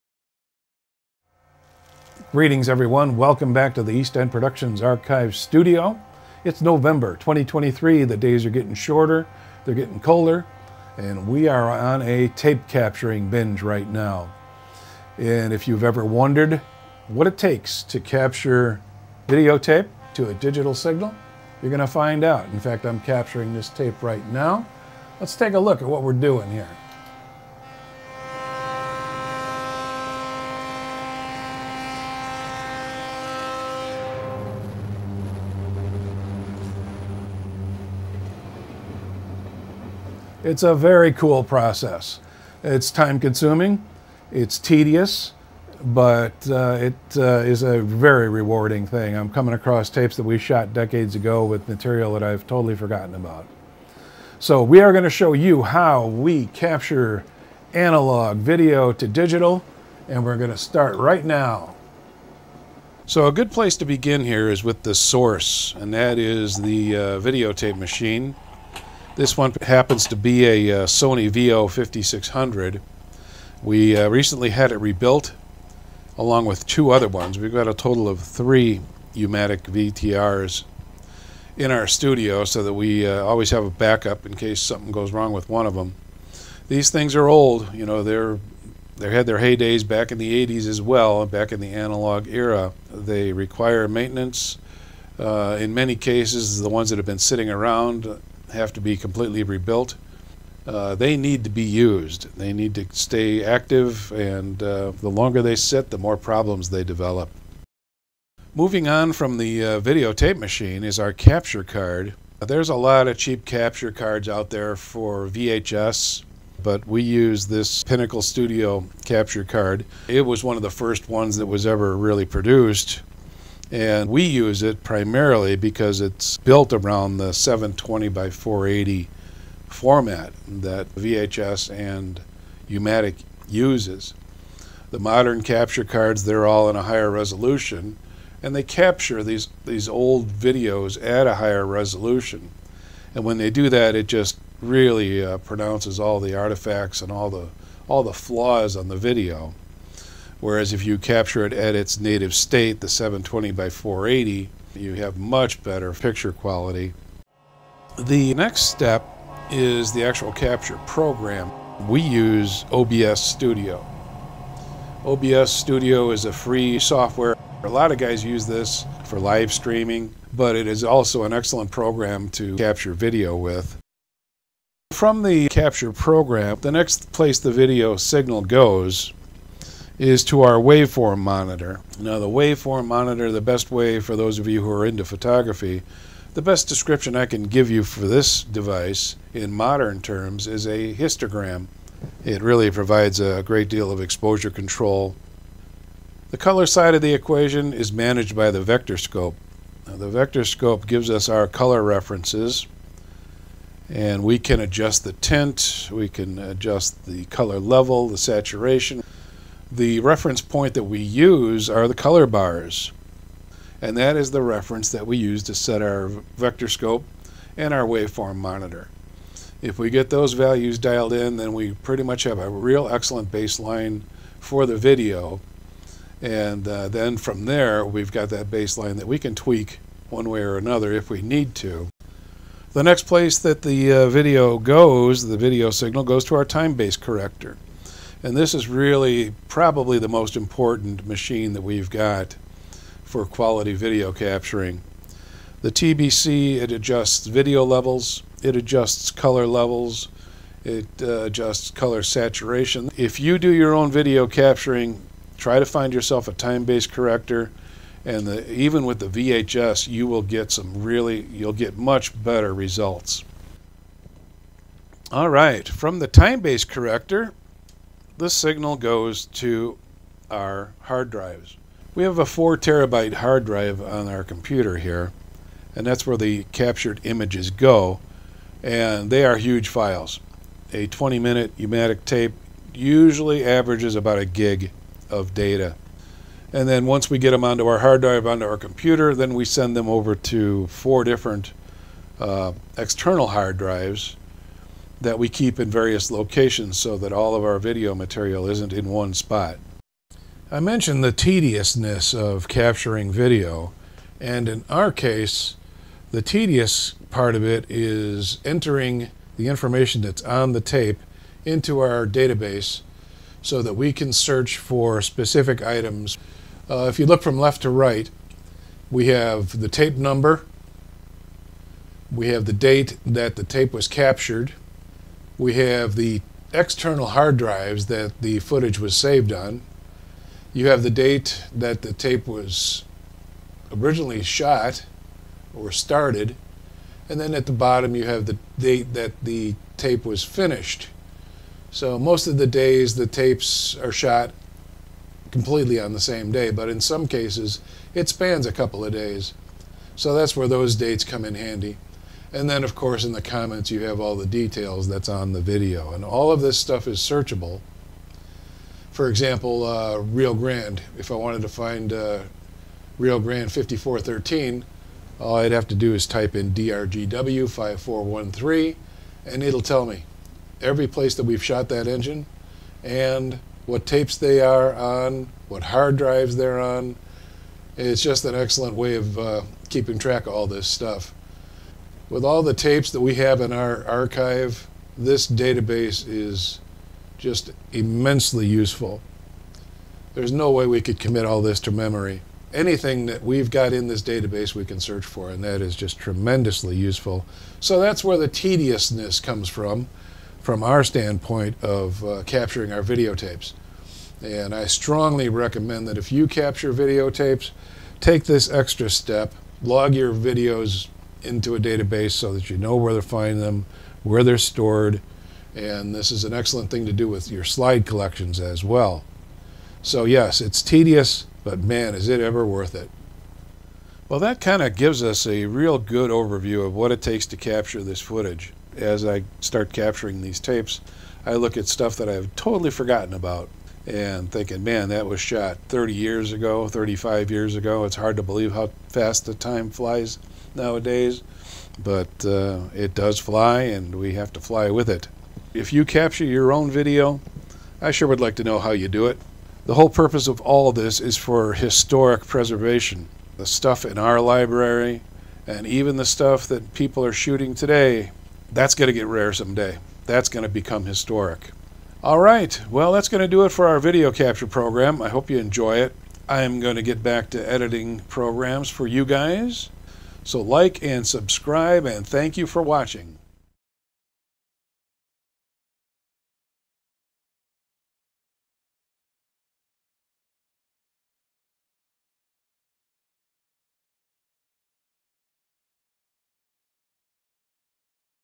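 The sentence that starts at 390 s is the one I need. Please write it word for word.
There's no way we could commit all this to memory.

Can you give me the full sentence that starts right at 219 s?
If we get those values dialed in, then we pretty much have a real excellent baseline for the video.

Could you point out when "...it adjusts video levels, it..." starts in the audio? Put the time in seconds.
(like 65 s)
246 s.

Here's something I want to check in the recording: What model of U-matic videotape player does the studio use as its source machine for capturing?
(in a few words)
Sony VO5600.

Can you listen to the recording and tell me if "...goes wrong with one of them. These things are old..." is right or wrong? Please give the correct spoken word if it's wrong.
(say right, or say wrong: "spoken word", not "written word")
right.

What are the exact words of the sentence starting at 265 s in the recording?
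All right, from the time-based corrector, this signal goes to our hard drives.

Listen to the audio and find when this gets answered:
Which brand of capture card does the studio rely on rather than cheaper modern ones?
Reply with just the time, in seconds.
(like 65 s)
117 s.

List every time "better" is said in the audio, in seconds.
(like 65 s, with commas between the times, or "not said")
155 s, 262 s.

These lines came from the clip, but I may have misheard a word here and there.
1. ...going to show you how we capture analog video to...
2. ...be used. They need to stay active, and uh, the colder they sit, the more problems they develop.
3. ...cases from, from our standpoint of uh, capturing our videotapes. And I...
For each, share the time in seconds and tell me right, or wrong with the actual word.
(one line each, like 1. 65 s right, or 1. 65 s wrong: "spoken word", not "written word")
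1. 54 s right
2. 101 s wrong: "longer", not "colder"
3. 399 s wrong: "comes", not "cases".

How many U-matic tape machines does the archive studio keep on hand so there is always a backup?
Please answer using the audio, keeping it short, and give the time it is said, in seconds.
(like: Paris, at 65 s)
3, at 78 s.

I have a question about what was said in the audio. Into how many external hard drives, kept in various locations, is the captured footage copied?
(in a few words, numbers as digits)
4.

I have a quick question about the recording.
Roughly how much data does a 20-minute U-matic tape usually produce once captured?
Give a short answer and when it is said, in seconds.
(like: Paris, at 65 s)
1 gig, at 284 s.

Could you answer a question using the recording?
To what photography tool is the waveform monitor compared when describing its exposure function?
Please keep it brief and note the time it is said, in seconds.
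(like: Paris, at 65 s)
histogram, at 190 s.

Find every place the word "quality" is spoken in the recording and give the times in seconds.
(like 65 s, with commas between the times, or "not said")
156 s, 243 s.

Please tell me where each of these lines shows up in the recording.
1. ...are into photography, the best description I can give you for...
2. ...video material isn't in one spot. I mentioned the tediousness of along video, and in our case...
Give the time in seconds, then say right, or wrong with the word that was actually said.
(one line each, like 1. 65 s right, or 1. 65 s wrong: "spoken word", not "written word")
1. 184 s right
2. 297 s wrong: "capturing", not "along".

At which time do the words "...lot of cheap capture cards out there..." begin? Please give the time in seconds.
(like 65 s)
112 s.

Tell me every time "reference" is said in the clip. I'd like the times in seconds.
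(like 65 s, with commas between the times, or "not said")
201 s, 210 s, 214 s.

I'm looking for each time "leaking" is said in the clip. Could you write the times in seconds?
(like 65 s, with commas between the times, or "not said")
not said.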